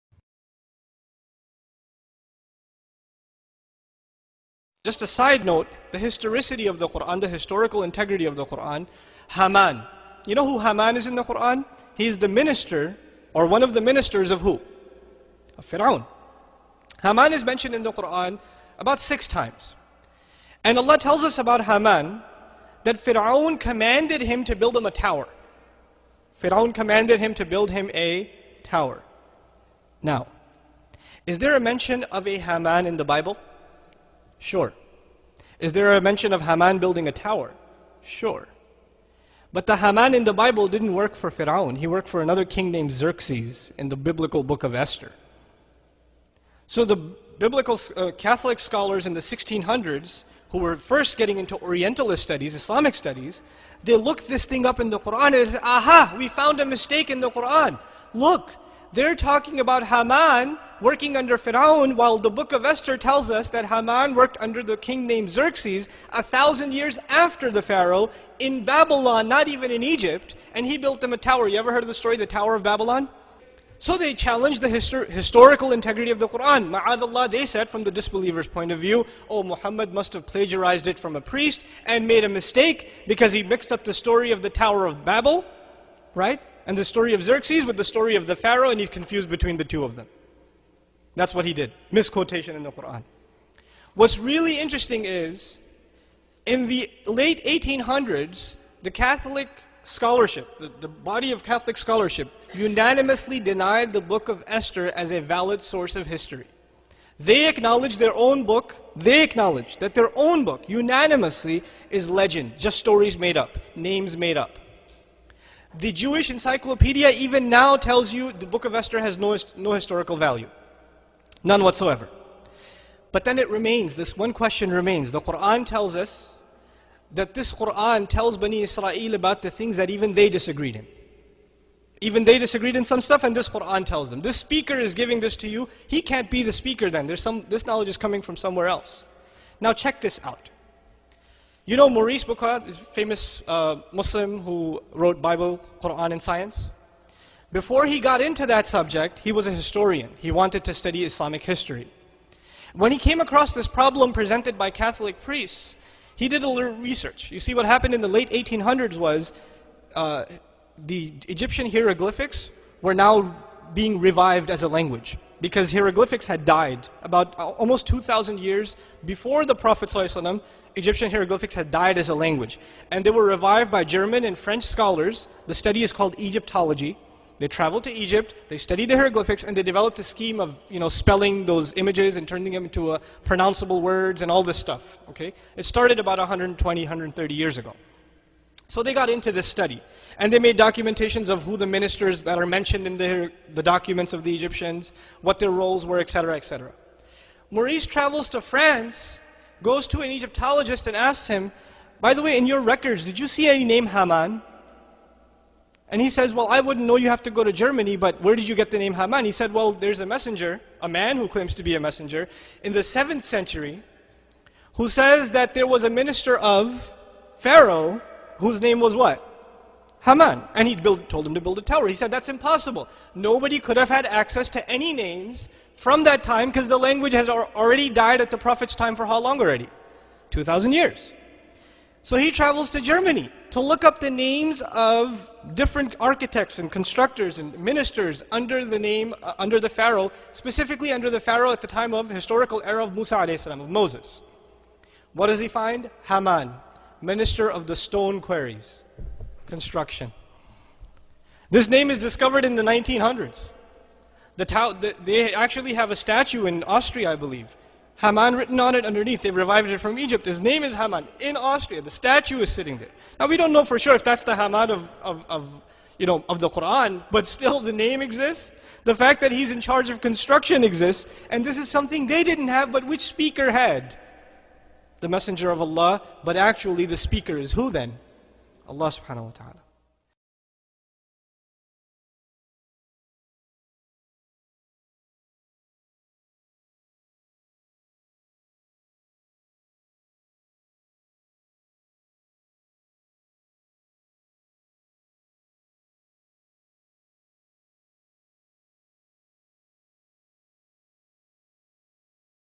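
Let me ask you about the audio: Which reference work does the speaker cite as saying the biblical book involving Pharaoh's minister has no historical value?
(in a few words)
The Jewish encyclopedia.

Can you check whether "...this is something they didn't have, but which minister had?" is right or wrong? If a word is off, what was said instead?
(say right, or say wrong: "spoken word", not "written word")
wrong: "speaker", not "minister".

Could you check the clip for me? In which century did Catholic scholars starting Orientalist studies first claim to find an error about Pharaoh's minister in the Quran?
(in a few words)
1600s.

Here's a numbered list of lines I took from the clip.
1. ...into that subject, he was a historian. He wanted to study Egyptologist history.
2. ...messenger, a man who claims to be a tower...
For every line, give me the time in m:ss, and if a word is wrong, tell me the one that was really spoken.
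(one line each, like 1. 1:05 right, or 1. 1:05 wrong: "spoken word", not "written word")
1. 2:28 wrong: "Islamic", not "Egyptologist"
2. 3:30 wrong: "messenger", not "tower".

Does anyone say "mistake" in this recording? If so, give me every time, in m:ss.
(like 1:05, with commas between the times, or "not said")
0:56, 1:22.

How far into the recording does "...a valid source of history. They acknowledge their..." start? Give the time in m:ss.
1:45.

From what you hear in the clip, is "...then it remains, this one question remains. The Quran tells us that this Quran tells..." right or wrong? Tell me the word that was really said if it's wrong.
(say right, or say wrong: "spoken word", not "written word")
right.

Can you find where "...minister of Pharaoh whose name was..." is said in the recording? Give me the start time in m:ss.
3:35.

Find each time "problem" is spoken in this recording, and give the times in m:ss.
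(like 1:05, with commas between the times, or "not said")
2:33.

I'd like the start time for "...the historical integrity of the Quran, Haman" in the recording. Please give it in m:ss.
0:07.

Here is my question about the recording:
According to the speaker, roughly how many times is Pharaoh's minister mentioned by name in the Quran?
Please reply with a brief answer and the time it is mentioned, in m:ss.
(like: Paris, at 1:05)
6, at 0:18.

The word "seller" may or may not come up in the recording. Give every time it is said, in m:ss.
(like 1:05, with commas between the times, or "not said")
not said.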